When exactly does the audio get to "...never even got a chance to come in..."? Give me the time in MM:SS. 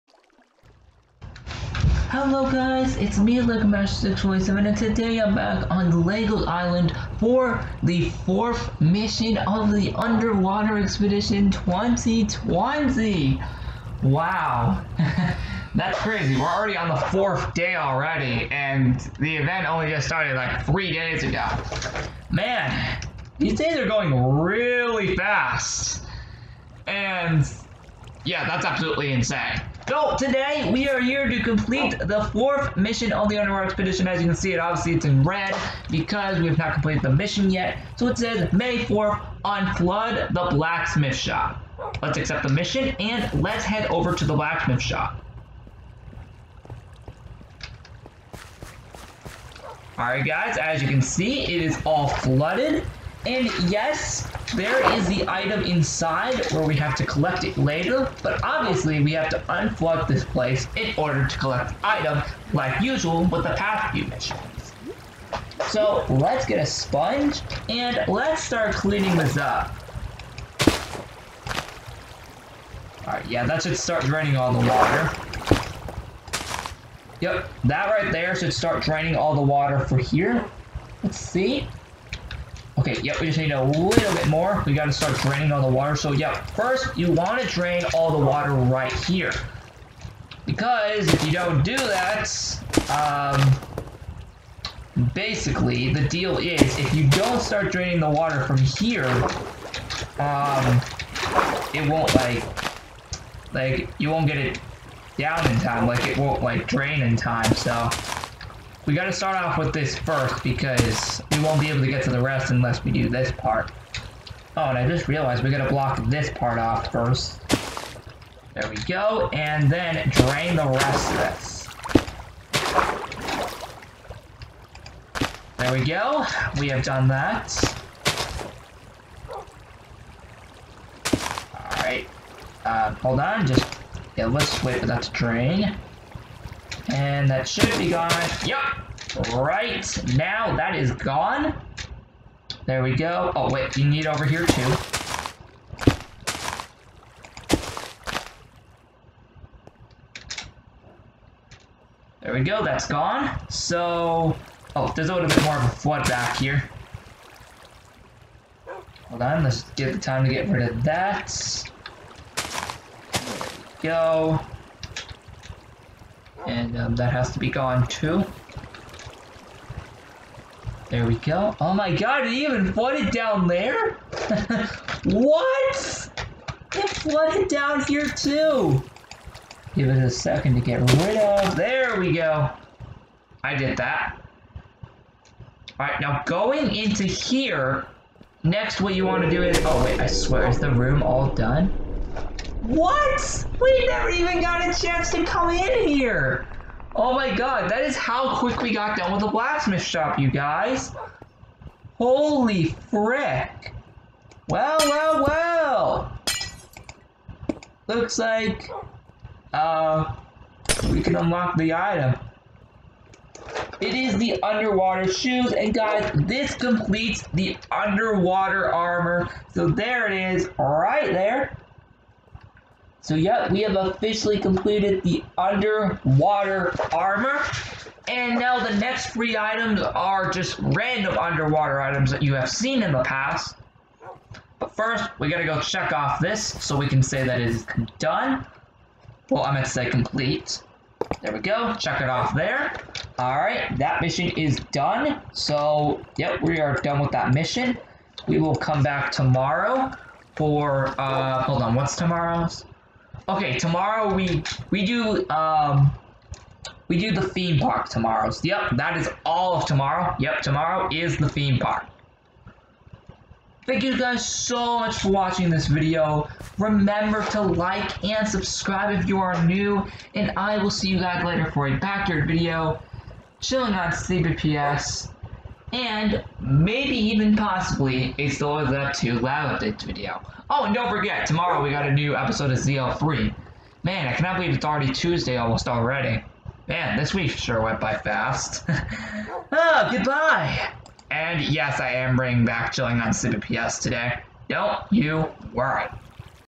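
03:13.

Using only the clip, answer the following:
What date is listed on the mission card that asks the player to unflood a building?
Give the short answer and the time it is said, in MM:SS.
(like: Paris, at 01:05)
May 4th, at 00:38.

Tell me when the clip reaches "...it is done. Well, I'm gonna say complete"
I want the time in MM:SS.
03:57.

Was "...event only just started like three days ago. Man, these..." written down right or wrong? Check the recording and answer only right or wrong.
right.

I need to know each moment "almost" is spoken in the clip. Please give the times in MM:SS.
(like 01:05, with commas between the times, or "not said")
04:45.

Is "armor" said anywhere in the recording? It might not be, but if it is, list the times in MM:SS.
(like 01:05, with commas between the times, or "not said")
03:38, 03:46.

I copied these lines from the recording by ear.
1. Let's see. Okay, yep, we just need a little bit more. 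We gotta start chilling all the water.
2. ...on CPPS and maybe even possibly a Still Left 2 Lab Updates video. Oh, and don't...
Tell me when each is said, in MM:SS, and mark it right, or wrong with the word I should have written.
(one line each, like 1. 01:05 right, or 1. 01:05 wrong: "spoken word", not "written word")
1. 01:21 wrong: "draining", not "chilling"
2. 04:33 right.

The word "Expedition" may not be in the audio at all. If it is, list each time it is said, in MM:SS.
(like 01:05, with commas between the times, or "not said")
00:10, 00:33.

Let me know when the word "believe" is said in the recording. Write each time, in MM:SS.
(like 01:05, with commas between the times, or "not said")
04:44.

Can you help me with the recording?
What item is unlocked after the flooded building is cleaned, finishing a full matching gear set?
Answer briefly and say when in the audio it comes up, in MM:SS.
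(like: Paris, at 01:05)
underwater shoes, at 03:34.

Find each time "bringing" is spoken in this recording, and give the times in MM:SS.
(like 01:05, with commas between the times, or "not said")
04:52.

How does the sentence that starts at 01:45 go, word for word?
Like it won't like drain in time.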